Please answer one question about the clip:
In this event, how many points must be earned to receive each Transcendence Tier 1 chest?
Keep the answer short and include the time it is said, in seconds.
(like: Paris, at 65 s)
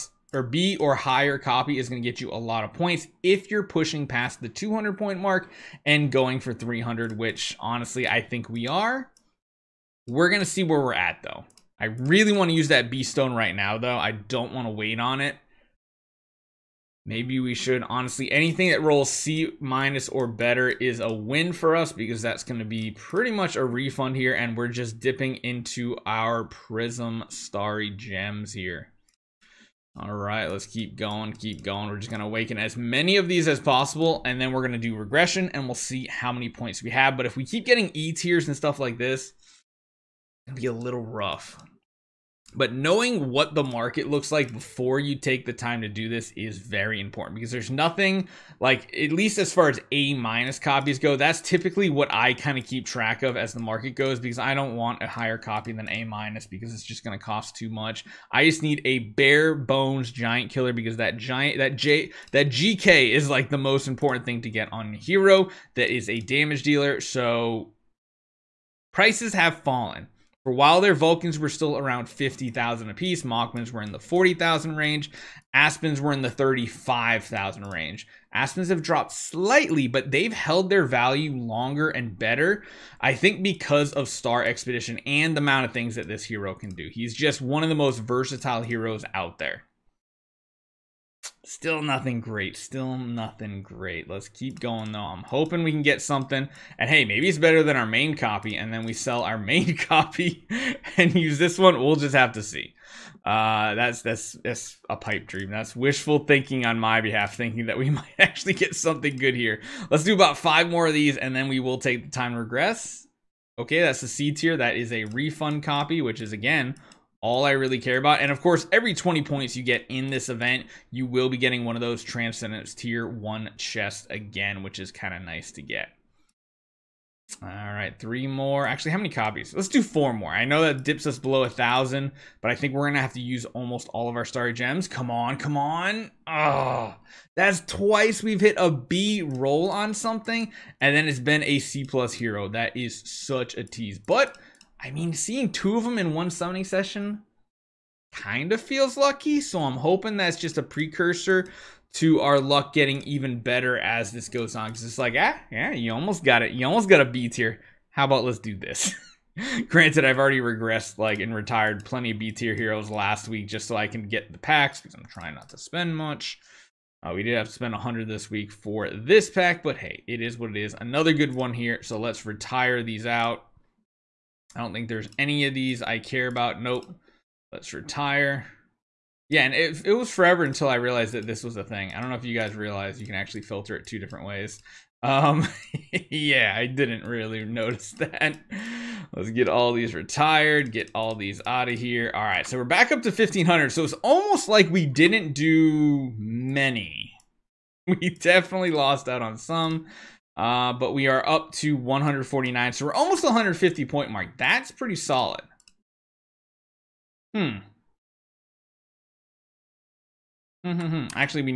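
20, at 118 s.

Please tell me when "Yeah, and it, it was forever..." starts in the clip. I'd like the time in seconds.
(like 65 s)
179 s.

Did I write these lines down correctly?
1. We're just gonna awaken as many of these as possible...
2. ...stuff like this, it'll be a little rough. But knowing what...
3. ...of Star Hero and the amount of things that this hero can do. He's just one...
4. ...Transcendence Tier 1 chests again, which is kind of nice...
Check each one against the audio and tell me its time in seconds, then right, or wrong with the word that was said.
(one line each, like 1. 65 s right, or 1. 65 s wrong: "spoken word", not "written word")
1. 31 s right
2. 38 s right
3. 83 s wrong: "Expedition", not "Hero"
4. 122 s right.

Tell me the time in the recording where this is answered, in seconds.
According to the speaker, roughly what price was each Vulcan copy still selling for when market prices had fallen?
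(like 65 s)
72 s.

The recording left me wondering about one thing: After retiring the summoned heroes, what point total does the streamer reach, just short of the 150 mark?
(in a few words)
149.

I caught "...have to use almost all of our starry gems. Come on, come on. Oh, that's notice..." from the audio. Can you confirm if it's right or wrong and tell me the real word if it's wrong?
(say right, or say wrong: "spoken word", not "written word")
wrong: "twice", not "notice".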